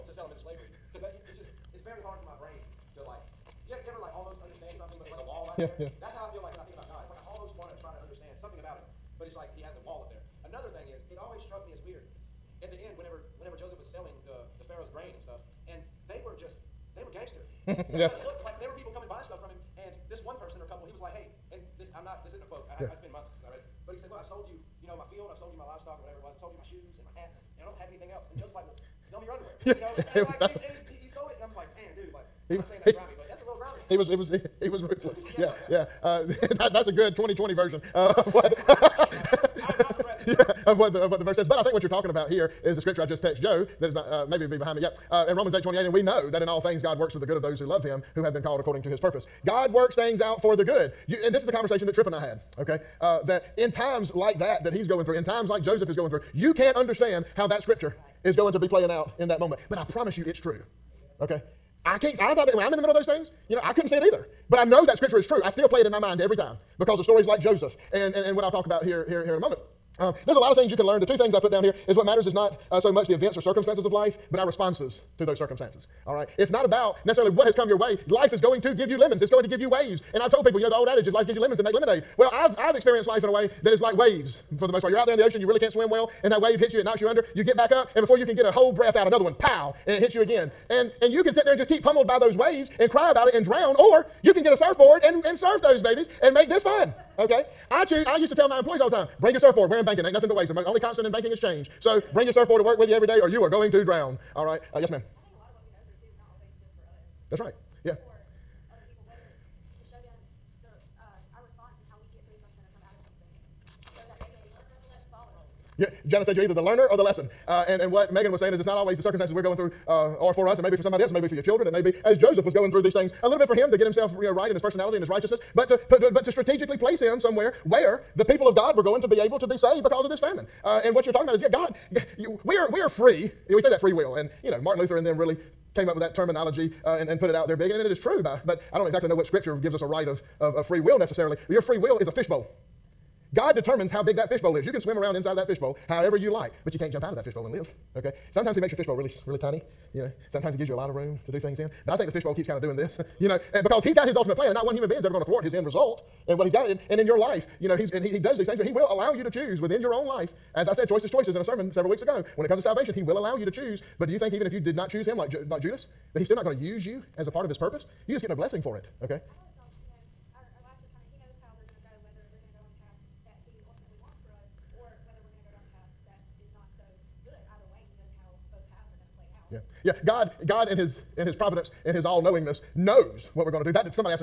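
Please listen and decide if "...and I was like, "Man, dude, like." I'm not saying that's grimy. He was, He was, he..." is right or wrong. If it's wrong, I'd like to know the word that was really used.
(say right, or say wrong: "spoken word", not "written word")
right.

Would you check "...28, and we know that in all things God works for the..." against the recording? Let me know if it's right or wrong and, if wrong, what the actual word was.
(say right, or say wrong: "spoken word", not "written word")
right.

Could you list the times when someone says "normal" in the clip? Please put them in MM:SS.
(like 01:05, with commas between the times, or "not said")
not said.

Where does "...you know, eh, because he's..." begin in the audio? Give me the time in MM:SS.
02:33.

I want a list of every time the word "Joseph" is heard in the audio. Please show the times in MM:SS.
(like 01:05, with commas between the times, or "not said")
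00:28, 00:55, 01:07, 02:02.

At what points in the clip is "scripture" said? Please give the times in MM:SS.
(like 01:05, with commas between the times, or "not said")
00:42, 00:57, 01:04, 02:19.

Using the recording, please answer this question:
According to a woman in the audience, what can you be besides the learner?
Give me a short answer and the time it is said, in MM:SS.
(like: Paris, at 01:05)
The lesson, at 01:56.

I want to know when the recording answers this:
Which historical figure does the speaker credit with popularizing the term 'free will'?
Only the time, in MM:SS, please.
02:14.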